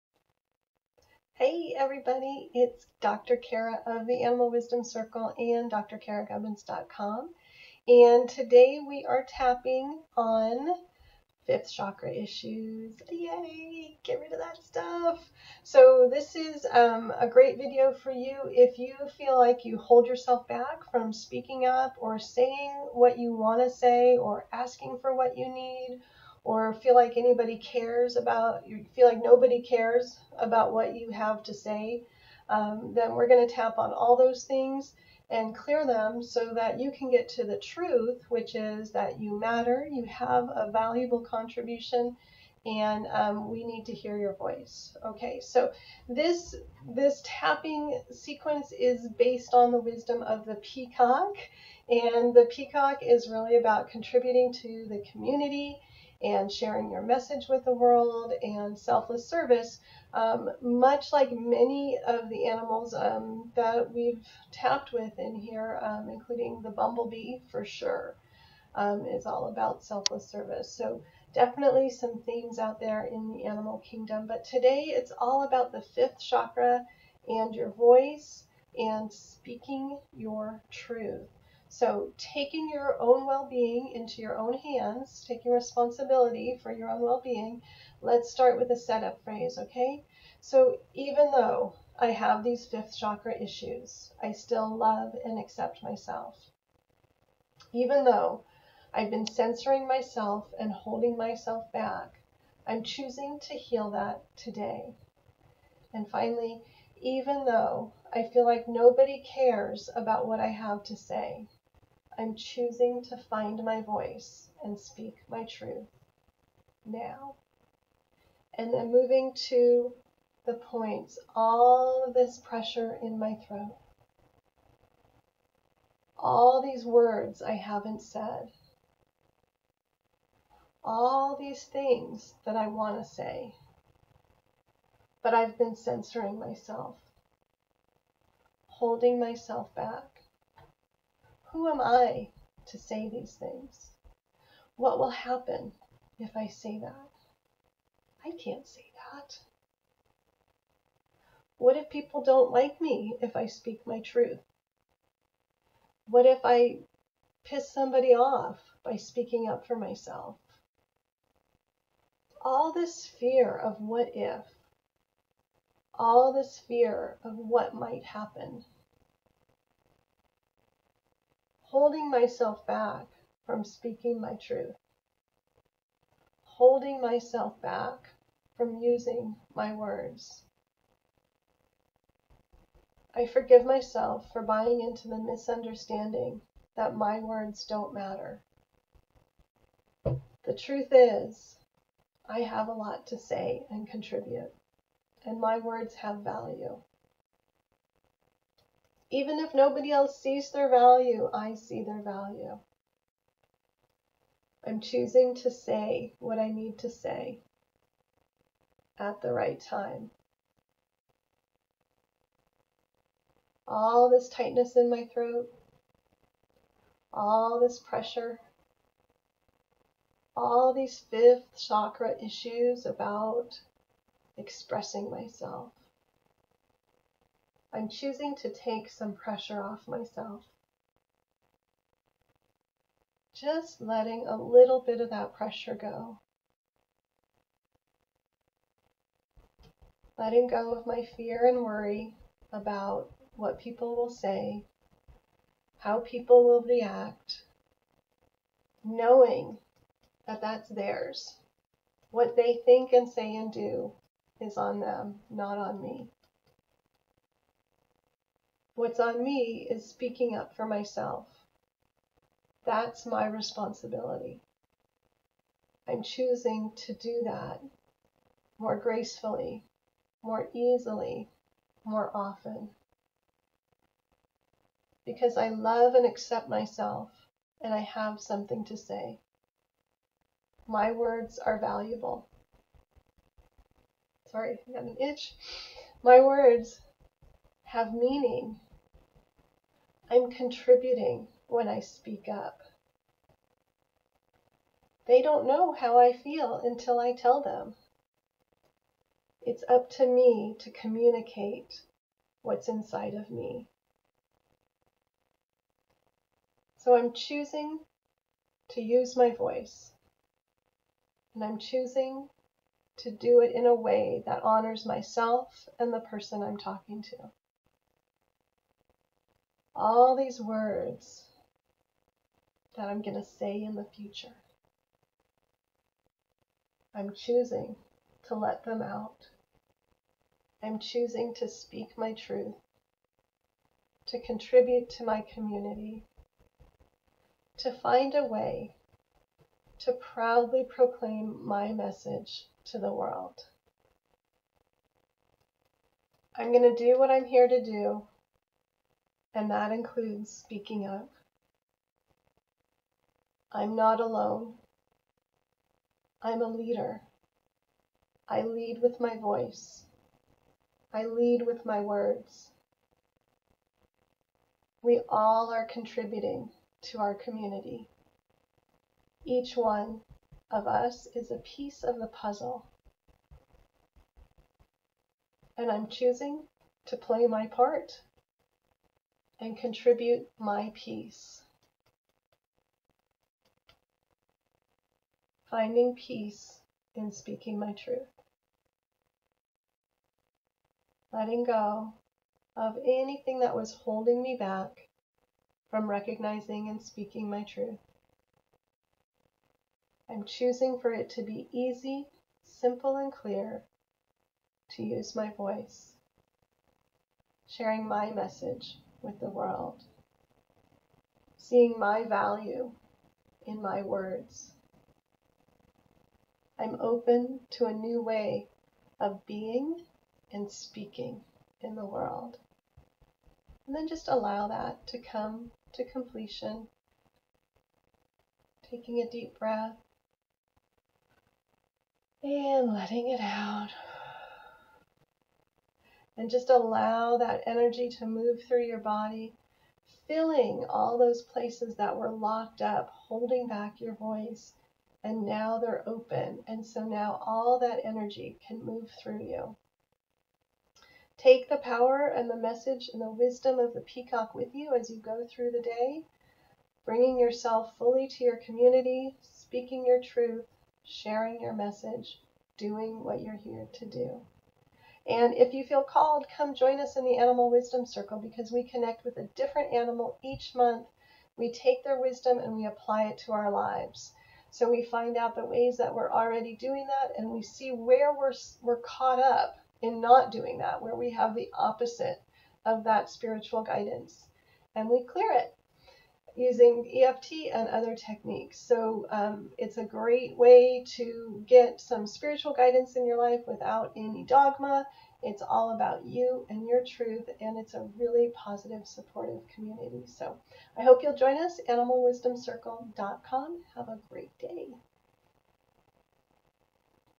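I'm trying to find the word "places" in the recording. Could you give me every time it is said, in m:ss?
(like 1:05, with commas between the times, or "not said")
7:21.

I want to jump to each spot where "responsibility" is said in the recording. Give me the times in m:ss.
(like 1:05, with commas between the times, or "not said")
1:25, 4:23.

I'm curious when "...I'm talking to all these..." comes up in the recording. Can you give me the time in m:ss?
5:16.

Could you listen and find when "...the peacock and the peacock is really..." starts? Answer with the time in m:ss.
0:50.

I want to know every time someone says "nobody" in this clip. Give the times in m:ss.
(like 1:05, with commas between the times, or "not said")
0:29, 1:48, 3:19.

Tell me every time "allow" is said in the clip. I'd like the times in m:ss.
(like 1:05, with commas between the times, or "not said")
7:04, 7:16.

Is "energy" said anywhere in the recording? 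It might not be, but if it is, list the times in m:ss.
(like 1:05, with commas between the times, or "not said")
7:17, 7:27.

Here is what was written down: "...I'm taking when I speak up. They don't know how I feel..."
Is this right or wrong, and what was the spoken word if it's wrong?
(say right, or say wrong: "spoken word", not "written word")
wrong: "contributing", not "taking".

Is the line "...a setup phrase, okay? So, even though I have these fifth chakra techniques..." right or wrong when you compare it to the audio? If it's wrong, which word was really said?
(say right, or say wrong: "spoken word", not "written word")
wrong: "issues", not "techniques".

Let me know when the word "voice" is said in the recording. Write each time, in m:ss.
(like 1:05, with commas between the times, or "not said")
0:44, 1:17, 1:53, 5:09, 5:59, 6:45, 7:23.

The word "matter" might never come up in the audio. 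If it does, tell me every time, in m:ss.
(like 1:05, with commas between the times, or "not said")
0:39, 3:07.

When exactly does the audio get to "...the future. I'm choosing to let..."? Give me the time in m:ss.
5:23.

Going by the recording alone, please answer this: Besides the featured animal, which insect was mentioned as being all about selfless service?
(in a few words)
Bumblebee.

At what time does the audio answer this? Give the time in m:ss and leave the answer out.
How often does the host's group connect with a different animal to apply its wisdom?
7:50.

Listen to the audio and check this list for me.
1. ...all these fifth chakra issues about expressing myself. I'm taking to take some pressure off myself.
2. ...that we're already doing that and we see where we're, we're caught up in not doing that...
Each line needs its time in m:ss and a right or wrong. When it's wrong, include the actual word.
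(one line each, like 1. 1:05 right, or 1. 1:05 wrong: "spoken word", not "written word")
1. 3:40 wrong: "choosing", not "taking"
2. 7:55 right.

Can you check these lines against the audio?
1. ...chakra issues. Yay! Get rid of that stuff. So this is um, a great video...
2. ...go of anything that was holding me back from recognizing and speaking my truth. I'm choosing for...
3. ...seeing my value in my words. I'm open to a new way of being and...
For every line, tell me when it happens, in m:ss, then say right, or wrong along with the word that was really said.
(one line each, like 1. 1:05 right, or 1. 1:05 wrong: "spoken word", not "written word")
1. 0:11 right
2. 6:31 right
3. 6:51 right.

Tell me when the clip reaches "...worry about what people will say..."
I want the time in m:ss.
4:01.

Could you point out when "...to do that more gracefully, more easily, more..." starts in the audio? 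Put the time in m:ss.
4:26.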